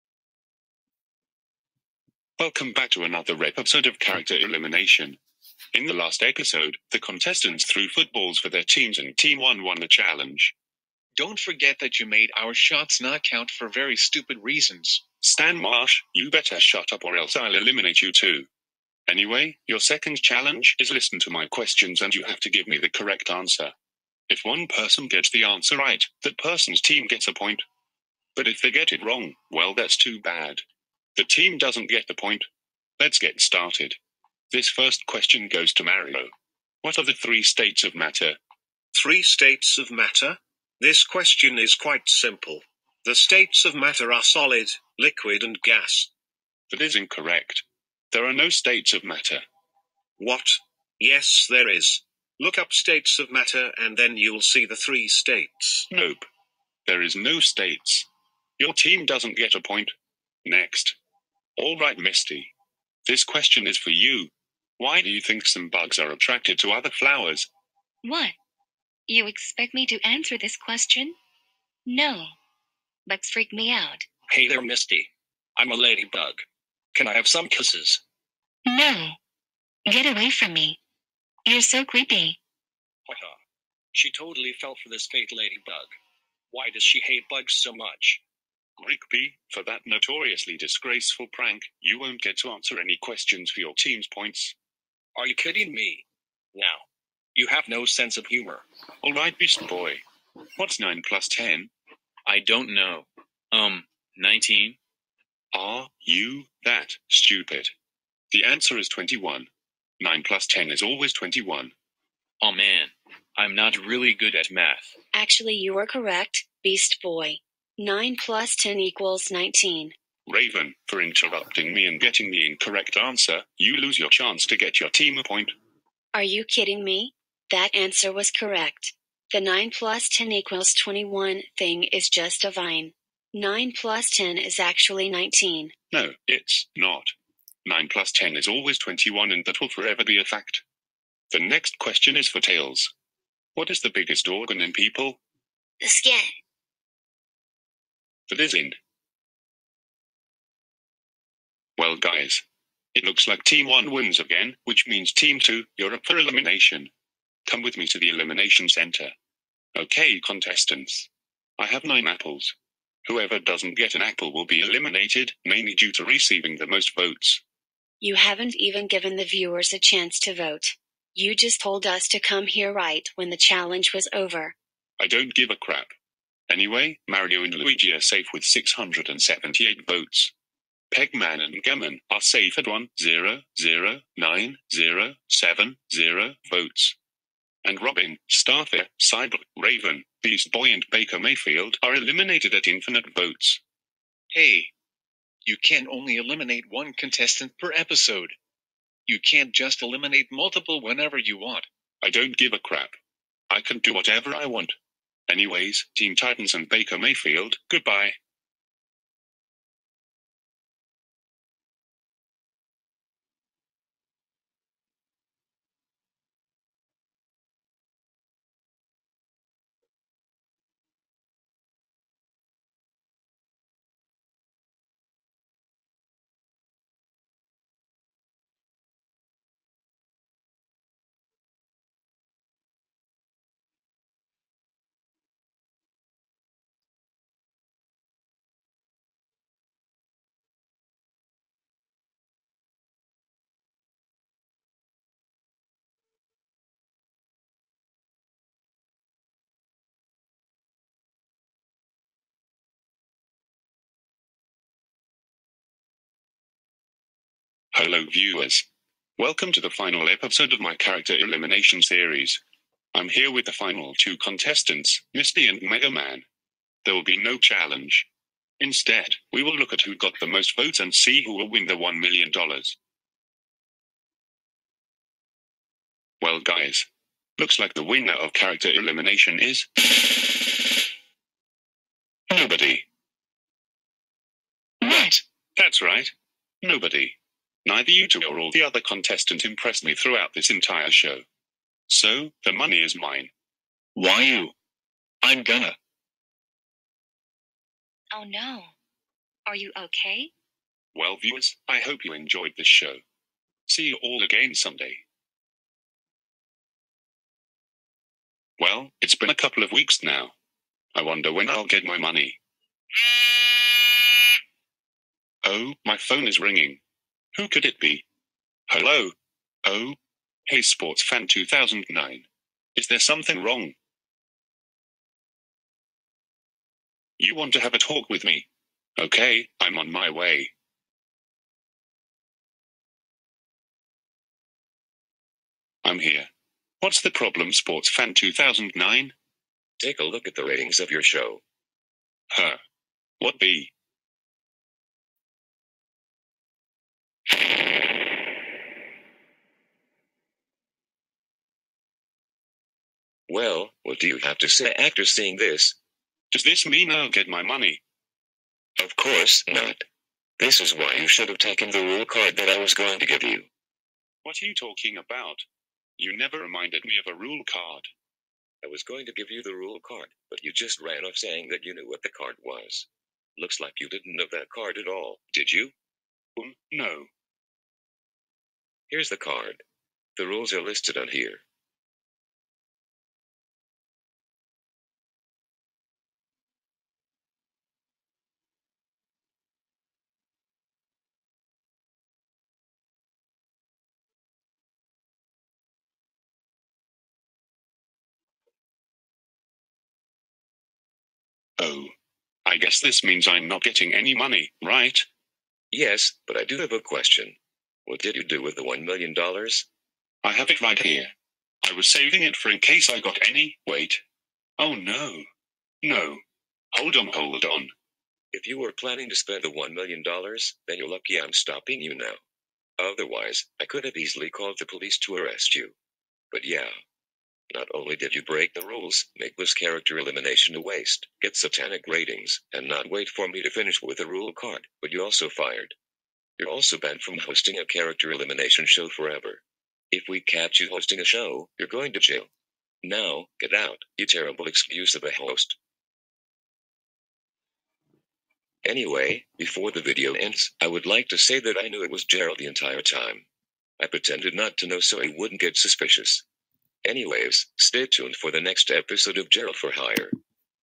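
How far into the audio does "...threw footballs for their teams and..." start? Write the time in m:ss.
0:07.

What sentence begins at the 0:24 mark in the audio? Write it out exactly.
If one person gets the answer right, that person's team gets a point.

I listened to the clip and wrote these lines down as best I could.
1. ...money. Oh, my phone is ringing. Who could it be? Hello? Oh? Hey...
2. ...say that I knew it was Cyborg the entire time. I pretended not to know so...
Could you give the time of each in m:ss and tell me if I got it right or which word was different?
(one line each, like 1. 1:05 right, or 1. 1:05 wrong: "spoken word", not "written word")
1. 5:11 right
2. 7:31 wrong: "Gerald", not "Cyborg".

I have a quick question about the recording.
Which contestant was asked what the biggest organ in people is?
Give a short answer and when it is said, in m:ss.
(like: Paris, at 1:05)
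Tails, at 2:22.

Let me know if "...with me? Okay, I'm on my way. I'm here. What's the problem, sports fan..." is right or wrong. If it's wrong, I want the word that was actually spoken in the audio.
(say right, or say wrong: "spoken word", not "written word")
right.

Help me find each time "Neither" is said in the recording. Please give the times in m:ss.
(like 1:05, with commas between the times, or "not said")
4:47.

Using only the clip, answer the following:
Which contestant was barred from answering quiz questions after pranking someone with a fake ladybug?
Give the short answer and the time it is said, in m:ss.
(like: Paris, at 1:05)
Rigby, at 1:28.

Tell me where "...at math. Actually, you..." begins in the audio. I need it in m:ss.
1:54.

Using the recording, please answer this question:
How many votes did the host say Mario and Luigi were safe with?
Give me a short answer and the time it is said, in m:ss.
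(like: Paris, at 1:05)
678, at 2:58.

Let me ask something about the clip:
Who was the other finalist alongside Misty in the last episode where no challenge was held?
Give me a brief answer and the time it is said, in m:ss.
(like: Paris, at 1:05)
Mega Man, at 4:25.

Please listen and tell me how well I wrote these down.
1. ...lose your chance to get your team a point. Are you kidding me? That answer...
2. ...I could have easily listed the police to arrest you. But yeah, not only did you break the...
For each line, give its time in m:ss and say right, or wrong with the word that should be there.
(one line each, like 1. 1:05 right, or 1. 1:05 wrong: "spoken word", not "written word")
1. 2:03 right
2. 7:03 wrong: "called", not "listed".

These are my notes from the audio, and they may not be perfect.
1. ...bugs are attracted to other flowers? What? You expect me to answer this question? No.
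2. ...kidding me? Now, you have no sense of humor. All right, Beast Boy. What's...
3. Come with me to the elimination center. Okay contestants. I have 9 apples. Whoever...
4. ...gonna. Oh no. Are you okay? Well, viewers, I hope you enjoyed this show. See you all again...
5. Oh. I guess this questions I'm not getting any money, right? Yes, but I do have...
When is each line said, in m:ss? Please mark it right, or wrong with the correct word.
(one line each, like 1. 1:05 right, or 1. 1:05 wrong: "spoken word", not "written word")
1. 1:05 right
2. 1:35 right
3. 2:37 right
4. 4:55 right
5. 6:41 wrong: "means", not "questions".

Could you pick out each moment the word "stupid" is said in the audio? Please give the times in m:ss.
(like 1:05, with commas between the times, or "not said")
0:13, 1:47.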